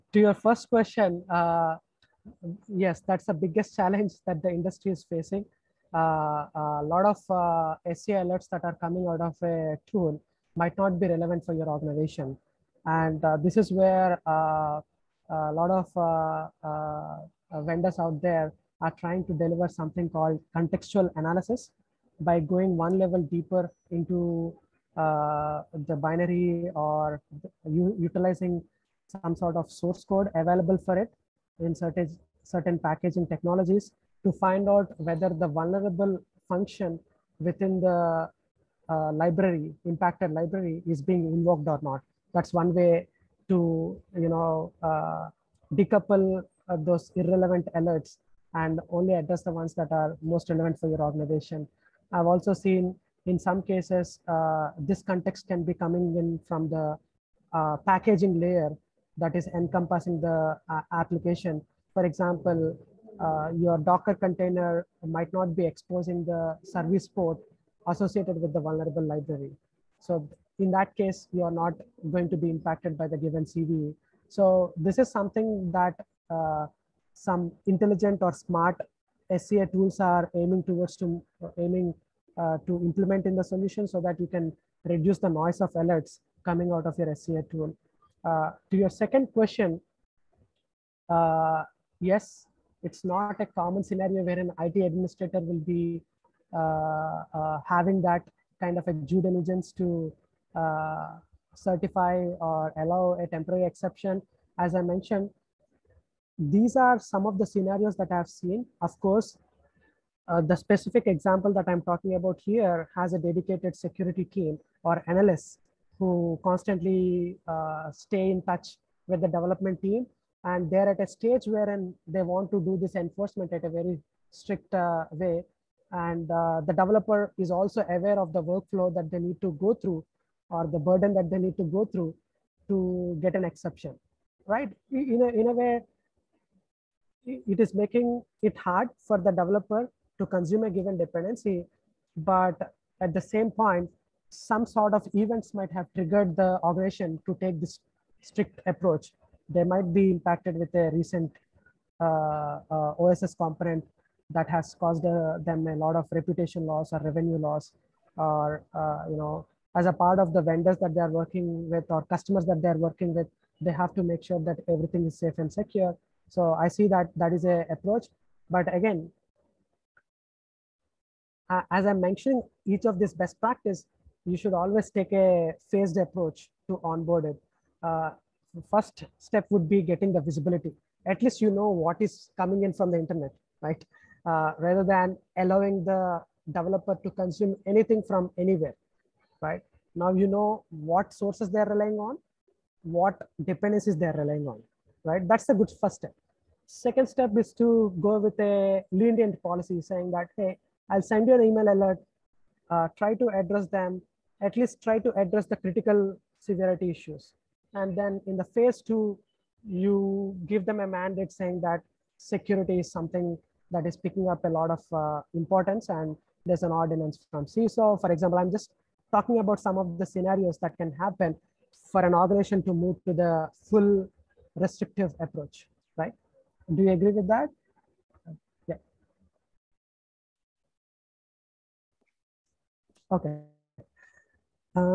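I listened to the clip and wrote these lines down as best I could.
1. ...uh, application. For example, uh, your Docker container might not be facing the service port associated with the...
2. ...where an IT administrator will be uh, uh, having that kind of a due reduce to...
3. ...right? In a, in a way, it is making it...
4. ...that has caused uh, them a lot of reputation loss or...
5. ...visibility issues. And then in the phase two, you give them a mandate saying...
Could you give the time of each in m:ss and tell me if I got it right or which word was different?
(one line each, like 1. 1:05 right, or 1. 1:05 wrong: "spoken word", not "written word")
1. 1:00 wrong: "exposing", not "facing"
2. 1:34 wrong: "diligence", not "reduce"
3. 2:14 right
4. 2:34 right
5. 3:26 wrong: "severity", not "visibility".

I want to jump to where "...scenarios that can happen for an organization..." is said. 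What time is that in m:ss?
3:40.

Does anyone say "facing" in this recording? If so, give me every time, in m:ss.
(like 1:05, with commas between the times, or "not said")
0:05.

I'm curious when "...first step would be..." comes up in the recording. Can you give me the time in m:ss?
2:58.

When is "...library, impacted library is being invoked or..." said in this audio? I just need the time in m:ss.
0:39.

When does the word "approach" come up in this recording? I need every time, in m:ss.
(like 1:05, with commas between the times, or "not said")
2:28, 2:47, 2:55, 3:45.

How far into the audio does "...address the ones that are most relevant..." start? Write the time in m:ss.
0:49.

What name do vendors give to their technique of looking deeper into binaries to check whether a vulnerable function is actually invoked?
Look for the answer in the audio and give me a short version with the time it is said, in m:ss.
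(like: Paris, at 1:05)
contextual analysis, at 0:20.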